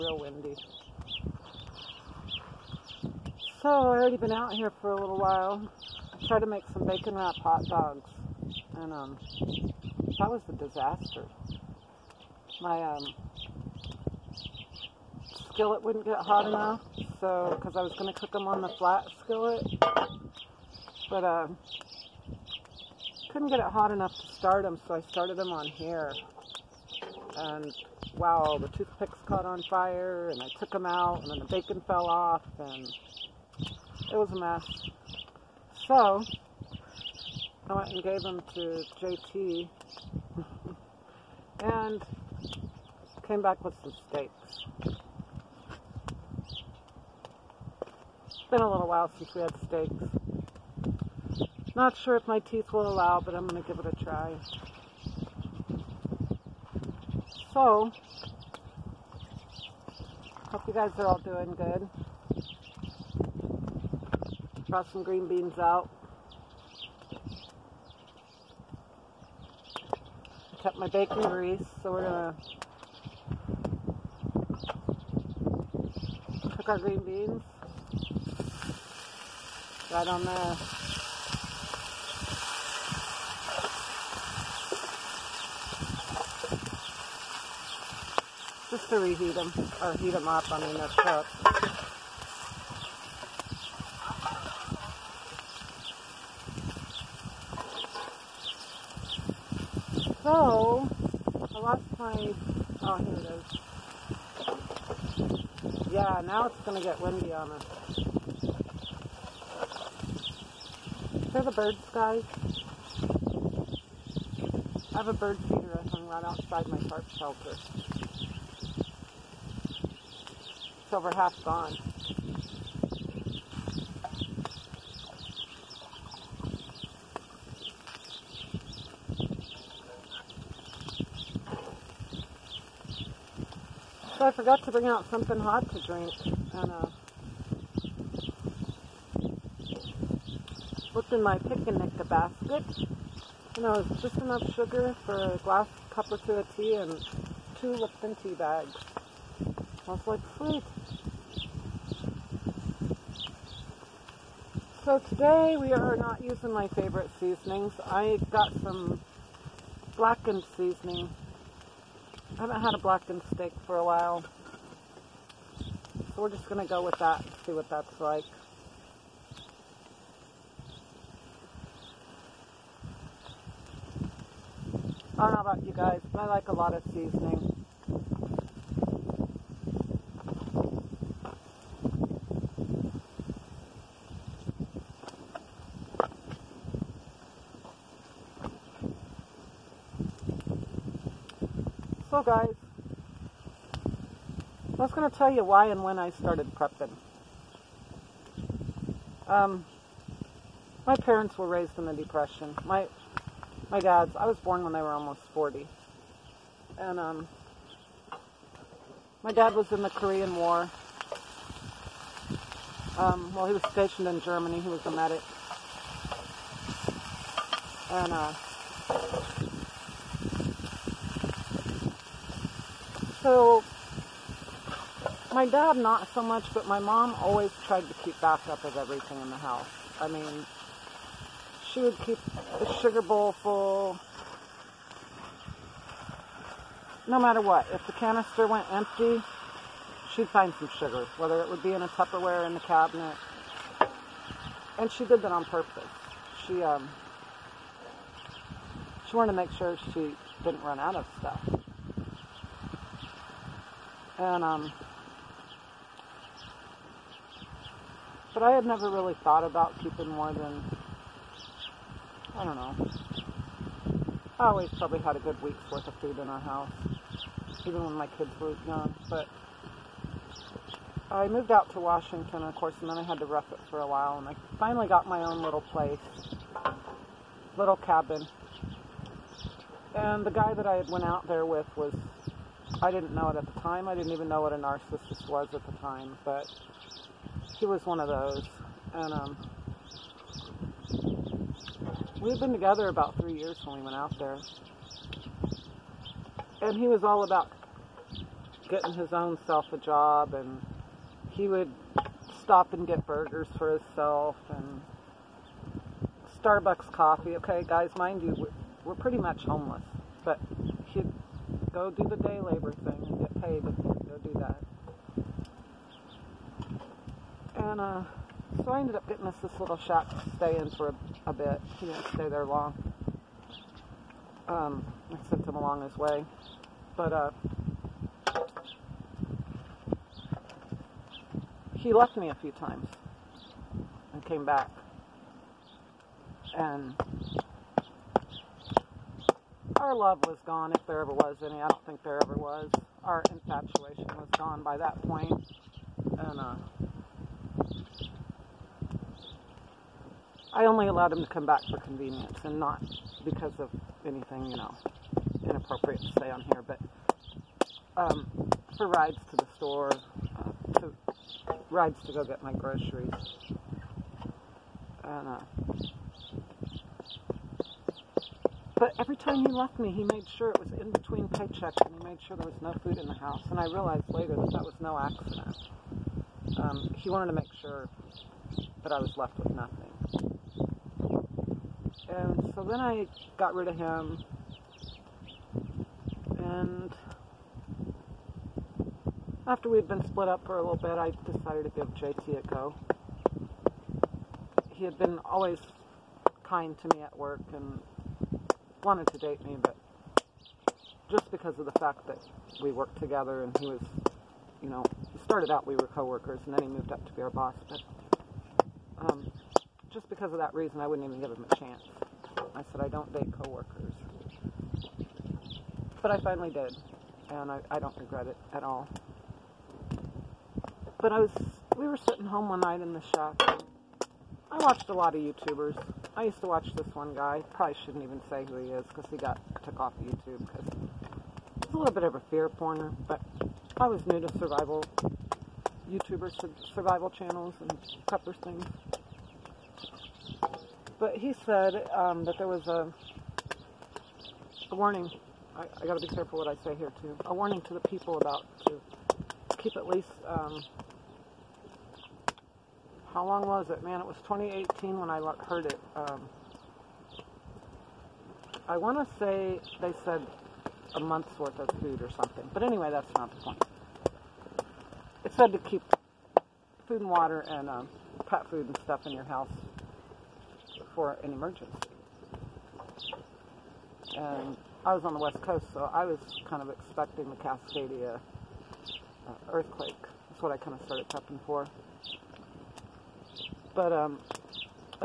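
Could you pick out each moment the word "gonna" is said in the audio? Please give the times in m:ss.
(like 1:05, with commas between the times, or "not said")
1:12.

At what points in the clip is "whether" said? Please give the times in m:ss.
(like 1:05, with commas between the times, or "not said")
4:01.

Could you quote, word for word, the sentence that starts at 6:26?
And after we had been split up for a little bit, I decided to give JT a go.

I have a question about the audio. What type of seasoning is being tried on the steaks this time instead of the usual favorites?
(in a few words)
blackened seasoning.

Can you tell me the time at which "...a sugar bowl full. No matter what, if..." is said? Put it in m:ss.
3:52.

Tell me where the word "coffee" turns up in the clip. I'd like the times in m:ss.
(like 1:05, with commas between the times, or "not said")
5:06.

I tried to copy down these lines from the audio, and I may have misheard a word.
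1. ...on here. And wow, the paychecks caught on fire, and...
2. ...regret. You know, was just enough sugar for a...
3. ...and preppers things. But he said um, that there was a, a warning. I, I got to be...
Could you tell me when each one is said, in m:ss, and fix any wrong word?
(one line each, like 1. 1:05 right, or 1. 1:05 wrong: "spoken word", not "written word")
1. 0:25 wrong: "toothpicks", not "paychecks"
2. 2:22 wrong: "basket", not "regret"
3. 7:17 right.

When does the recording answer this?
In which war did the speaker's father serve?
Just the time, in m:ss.
3:29.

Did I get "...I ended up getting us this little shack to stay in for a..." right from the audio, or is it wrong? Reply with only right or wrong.
right.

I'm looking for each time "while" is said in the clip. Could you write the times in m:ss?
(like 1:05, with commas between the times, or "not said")
0:05, 0:48, 2:43, 4:33.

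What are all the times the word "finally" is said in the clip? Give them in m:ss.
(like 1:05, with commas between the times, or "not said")
4:34, 6:56.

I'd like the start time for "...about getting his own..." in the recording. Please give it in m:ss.
4:57.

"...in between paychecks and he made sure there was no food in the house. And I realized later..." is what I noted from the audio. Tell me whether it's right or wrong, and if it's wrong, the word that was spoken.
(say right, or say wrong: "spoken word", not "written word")
right.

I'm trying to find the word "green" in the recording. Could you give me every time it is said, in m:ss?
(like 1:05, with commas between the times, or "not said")
1:05, 1:16.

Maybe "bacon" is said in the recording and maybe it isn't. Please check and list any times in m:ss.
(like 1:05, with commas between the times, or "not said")
0:06, 0:31, 1:10.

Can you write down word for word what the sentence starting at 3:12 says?
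guys, I was going to tell you why and when I started prepping.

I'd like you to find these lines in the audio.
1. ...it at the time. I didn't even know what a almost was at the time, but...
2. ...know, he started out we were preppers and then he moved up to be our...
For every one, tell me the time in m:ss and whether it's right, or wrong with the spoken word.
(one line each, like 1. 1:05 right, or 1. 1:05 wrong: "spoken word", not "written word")
1. 4:43 wrong: "narcissist", not "almost"
2. 6:44 wrong: "coworkers", not "preppers".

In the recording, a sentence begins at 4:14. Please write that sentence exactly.
And um, but I had never really thought about keeping more than I don't know.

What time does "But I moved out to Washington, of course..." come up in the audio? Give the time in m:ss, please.
4:29.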